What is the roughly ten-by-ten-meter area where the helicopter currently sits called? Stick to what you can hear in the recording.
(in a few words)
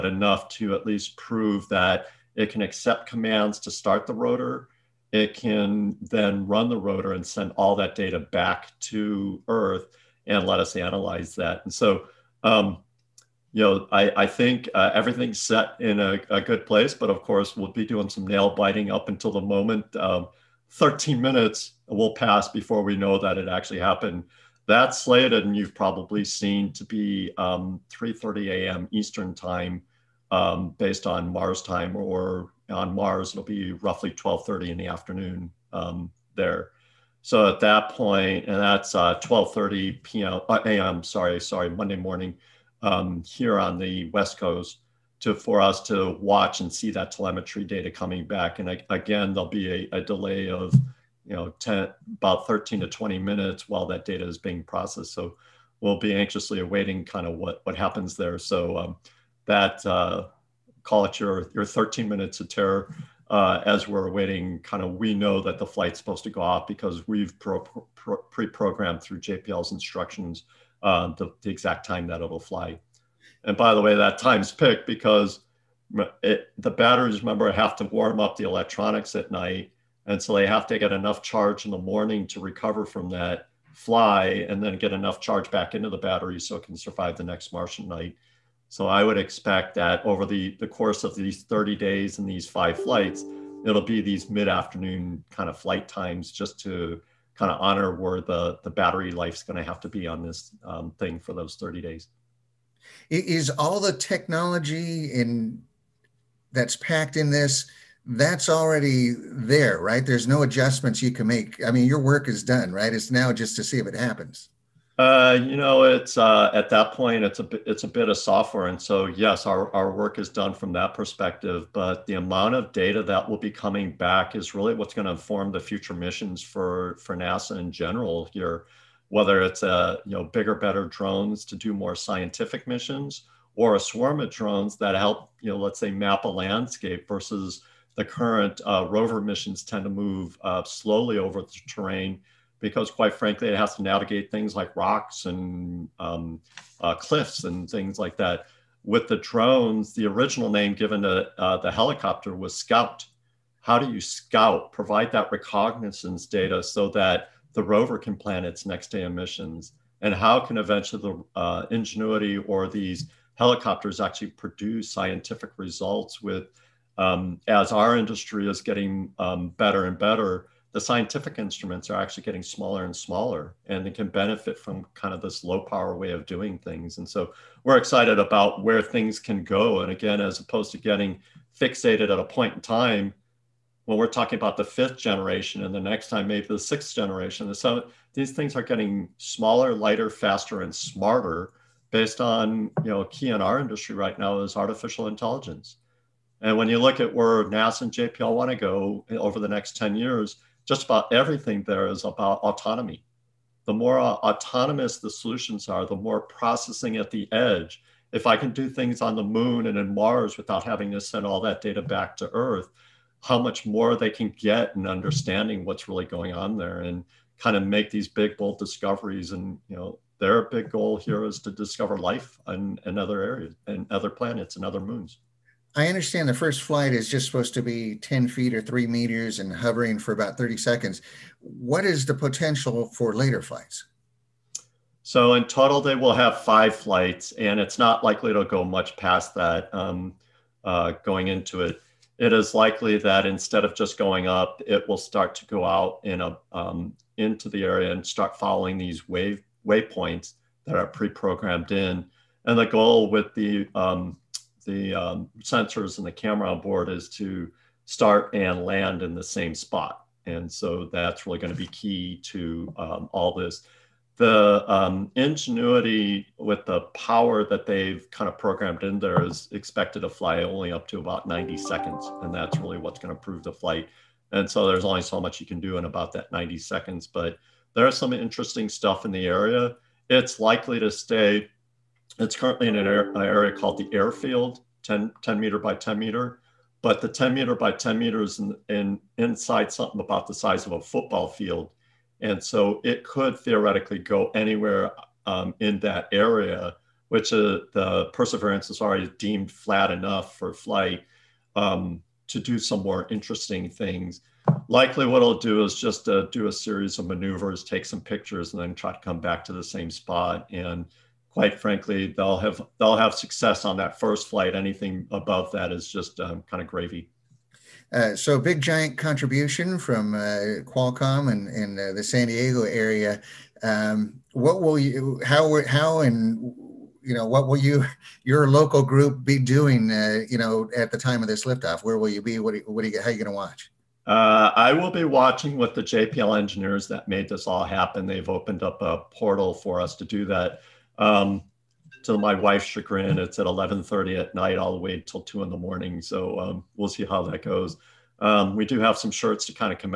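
the airfield.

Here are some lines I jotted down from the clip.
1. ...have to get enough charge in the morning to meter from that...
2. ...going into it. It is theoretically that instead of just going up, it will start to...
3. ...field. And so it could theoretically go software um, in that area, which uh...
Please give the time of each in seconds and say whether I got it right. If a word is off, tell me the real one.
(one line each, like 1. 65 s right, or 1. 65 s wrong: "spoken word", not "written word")
1. 80 s wrong: "recover", not "meter"
2. 241 s wrong: "likely", not "theoretically"
3. 291 s wrong: "anywhere", not "software".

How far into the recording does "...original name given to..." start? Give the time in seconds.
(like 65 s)
150 s.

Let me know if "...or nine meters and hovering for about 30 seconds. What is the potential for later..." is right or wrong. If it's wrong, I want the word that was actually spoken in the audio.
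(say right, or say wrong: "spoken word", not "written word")
wrong: "three", not "nine".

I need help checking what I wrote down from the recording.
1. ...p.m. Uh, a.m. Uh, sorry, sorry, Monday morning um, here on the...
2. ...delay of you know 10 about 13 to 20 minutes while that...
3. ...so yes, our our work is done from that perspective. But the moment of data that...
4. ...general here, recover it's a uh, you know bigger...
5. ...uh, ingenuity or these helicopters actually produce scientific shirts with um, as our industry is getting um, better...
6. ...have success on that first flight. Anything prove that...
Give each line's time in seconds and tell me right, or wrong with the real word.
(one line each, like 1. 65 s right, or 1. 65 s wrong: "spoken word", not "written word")
1. 40 s right
2. 50 s right
3. 118 s wrong: "amount", not "moment"
4. 127 s wrong: "whether", not "recover"
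5. 161 s wrong: "results", not "shirts"
6. 312 s wrong: "above", not "prove".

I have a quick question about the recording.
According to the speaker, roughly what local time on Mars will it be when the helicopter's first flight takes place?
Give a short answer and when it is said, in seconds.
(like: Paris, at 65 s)
12:30 in the afternoon, at 34 s.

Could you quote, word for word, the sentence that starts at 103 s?
Is all the technology in that's packed in this, that's already there, right?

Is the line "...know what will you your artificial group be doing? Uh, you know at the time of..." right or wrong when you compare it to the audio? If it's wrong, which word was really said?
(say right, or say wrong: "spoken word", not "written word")
wrong: "local", not "artificial".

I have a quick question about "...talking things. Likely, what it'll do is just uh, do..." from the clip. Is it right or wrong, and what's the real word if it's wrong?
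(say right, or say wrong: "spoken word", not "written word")
wrong: "interesting", not "talking".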